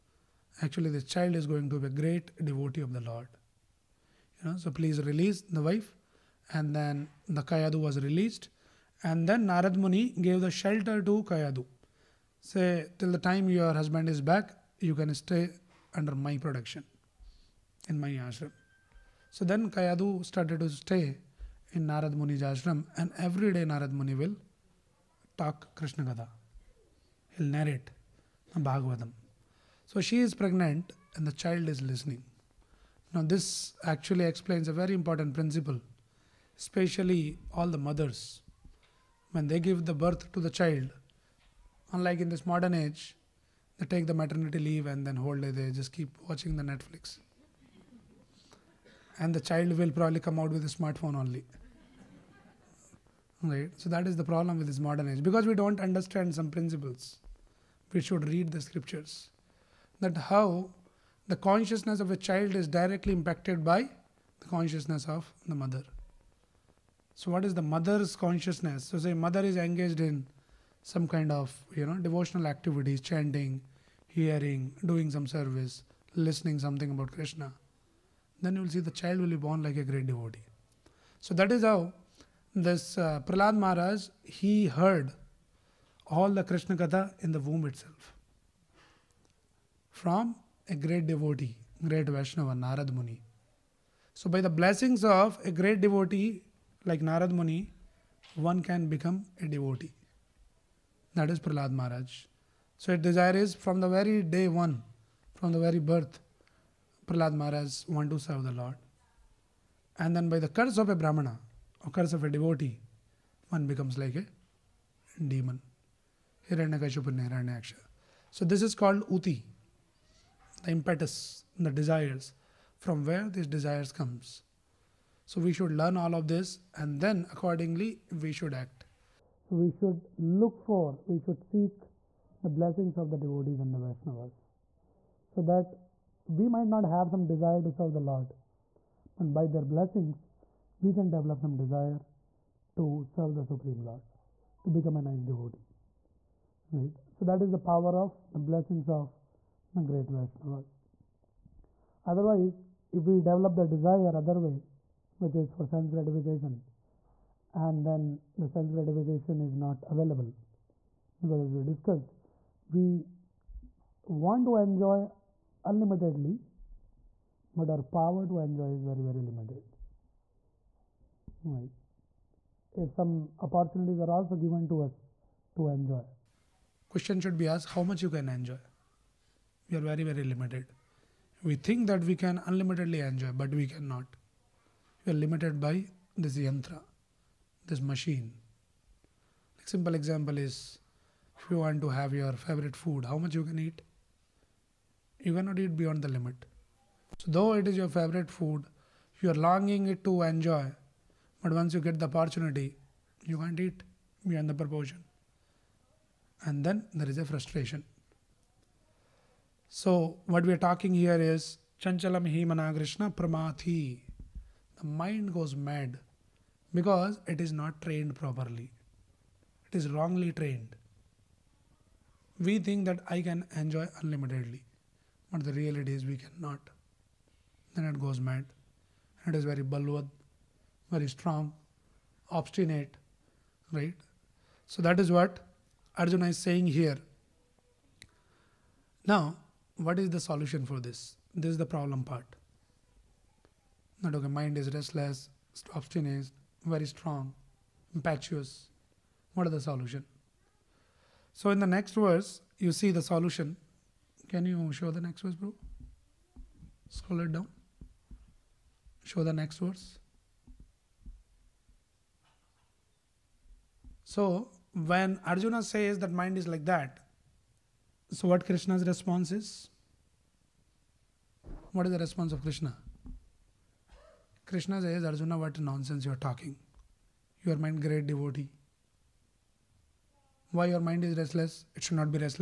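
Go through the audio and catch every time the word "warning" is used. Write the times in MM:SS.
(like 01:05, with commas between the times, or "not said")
not said.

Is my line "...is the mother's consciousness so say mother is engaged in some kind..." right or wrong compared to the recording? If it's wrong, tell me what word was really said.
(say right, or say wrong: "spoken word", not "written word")
right.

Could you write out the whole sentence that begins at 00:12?
Say, till the time your husband is back, you can stay under my protection in my ashram.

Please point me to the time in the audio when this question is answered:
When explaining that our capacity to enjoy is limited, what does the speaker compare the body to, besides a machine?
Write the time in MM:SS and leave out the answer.
03:06.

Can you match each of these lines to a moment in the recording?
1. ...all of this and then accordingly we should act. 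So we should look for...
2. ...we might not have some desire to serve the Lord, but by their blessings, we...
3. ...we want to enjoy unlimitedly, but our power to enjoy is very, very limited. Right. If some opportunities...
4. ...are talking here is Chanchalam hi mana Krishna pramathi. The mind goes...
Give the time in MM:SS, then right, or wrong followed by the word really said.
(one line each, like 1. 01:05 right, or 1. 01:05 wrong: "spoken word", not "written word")
1. 02:05 right
2. 02:16 right
3. 02:42 right
4. 03:30 right.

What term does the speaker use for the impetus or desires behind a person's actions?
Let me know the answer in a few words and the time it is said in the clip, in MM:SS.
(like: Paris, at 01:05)
uti, at 01:59.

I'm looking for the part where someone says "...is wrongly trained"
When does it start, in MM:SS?
03:39.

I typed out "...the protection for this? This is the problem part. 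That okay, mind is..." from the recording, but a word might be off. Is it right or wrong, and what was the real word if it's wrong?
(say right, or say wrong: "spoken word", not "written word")
wrong: "solution", not "protection".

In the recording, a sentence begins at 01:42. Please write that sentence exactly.
So, his desire is from the very day one, from the very birth, Prahlad Maharaj want to serve the Lord.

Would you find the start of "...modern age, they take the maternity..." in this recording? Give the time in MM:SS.
00:42.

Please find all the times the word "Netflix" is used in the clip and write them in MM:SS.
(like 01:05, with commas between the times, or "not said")
00:46.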